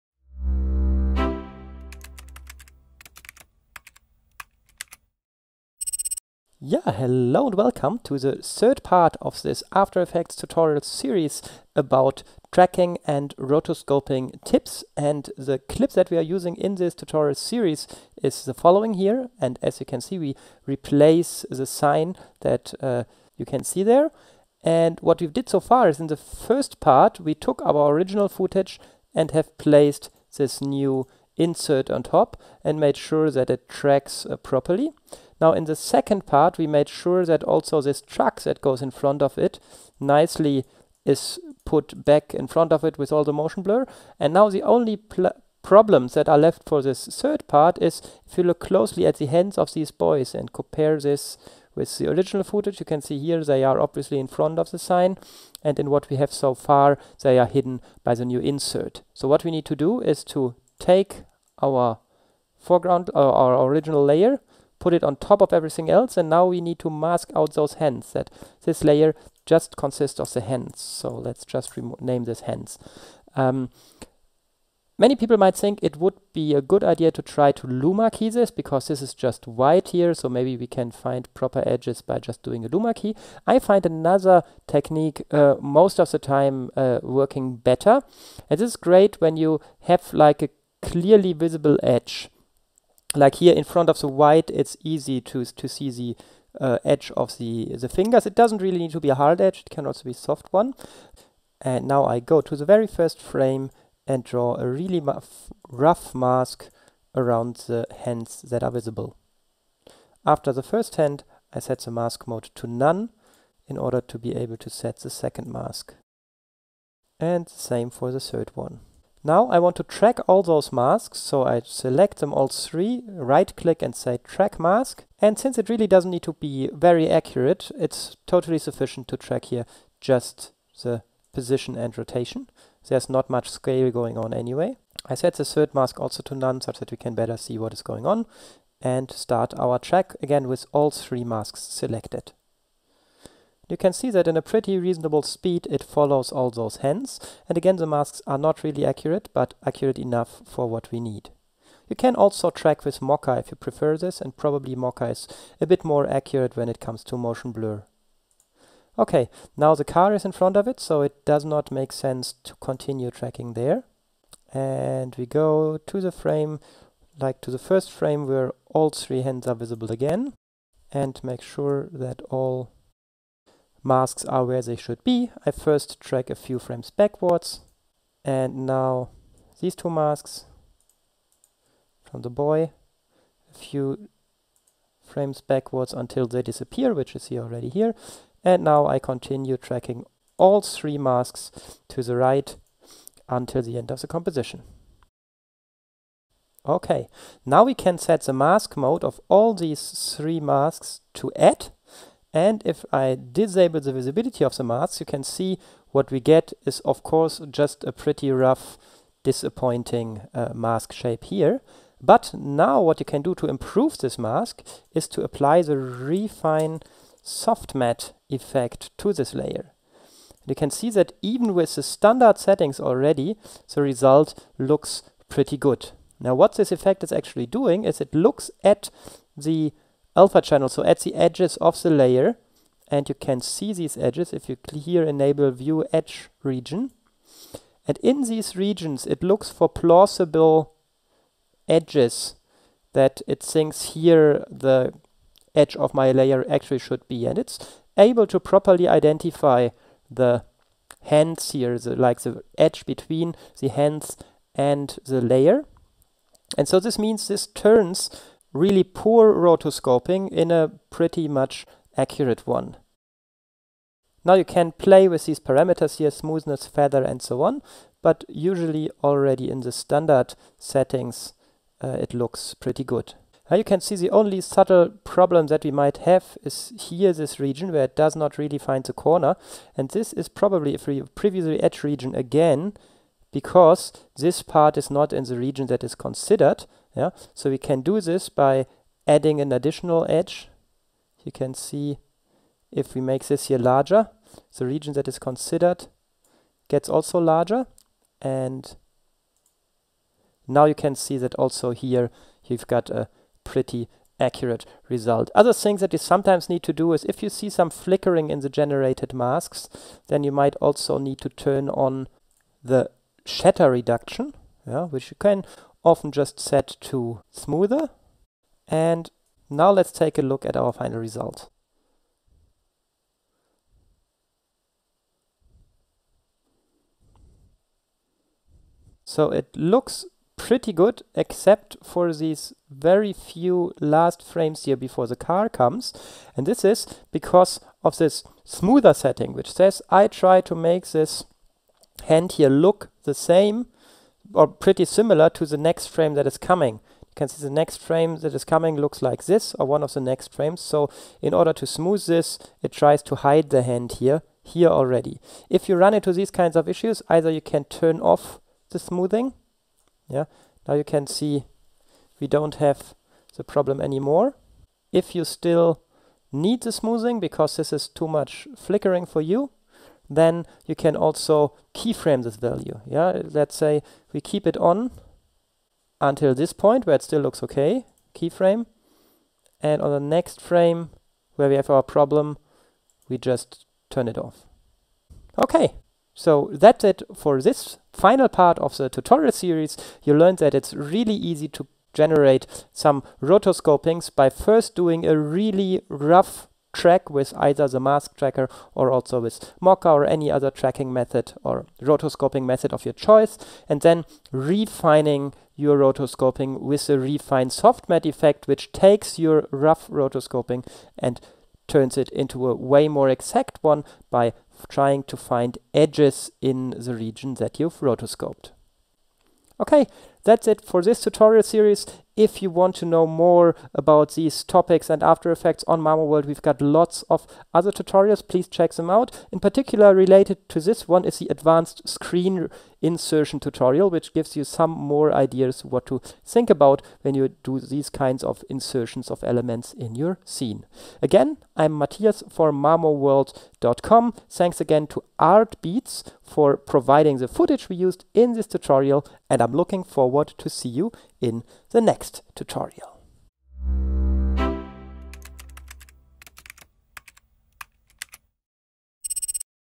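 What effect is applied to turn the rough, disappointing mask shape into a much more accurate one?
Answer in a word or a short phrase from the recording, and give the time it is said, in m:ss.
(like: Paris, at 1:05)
Refine Soft Matte, at 3:35.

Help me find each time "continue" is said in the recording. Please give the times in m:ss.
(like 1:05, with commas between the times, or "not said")
2:42, 3:08.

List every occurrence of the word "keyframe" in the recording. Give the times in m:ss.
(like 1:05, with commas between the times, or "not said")
6:11, 6:18.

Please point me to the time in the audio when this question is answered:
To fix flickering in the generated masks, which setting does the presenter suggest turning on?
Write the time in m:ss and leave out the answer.
5:13.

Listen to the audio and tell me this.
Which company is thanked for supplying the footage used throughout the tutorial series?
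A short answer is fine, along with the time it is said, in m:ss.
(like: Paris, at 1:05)
Artbeats, at 7:25.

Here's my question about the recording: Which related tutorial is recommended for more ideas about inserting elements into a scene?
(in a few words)
Advanced screen insertion.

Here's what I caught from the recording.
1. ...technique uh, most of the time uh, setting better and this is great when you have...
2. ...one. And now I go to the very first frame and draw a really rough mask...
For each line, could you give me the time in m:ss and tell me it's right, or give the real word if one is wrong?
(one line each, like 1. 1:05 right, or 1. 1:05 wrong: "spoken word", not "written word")
1. 1:24 wrong: "working", not "setting"
2. 1:40 right.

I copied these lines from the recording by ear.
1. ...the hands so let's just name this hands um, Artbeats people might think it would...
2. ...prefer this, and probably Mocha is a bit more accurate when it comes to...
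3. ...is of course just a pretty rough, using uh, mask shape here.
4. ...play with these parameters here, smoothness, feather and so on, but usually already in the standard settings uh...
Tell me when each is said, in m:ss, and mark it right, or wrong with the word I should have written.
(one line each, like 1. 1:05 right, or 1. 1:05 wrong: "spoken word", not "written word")
1. 1:10 wrong: "Many", not "Artbeats"
2. 2:33 right
3. 3:26 wrong: "disappointing", not "using"
4. 4:24 right.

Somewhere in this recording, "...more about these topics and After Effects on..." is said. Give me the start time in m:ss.
7:03.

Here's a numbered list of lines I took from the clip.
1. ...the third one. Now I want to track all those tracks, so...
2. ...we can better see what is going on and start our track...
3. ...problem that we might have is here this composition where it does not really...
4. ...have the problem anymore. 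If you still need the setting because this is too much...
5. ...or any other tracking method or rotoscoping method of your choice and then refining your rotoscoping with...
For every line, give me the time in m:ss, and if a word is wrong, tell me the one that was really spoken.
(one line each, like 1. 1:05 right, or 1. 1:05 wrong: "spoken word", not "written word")
1. 1:58 wrong: "masks", not "tracks"
2. 2:16 right
3. 4:35 wrong: "region", not "composition"
4. 6:02 wrong: "smoothing", not "setting"
5. 6:39 right.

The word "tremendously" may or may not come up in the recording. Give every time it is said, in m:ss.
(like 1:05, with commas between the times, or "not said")
not said.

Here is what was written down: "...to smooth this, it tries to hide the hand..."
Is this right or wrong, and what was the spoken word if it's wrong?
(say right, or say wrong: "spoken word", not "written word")
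right.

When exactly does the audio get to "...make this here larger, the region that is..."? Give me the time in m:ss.
4:53.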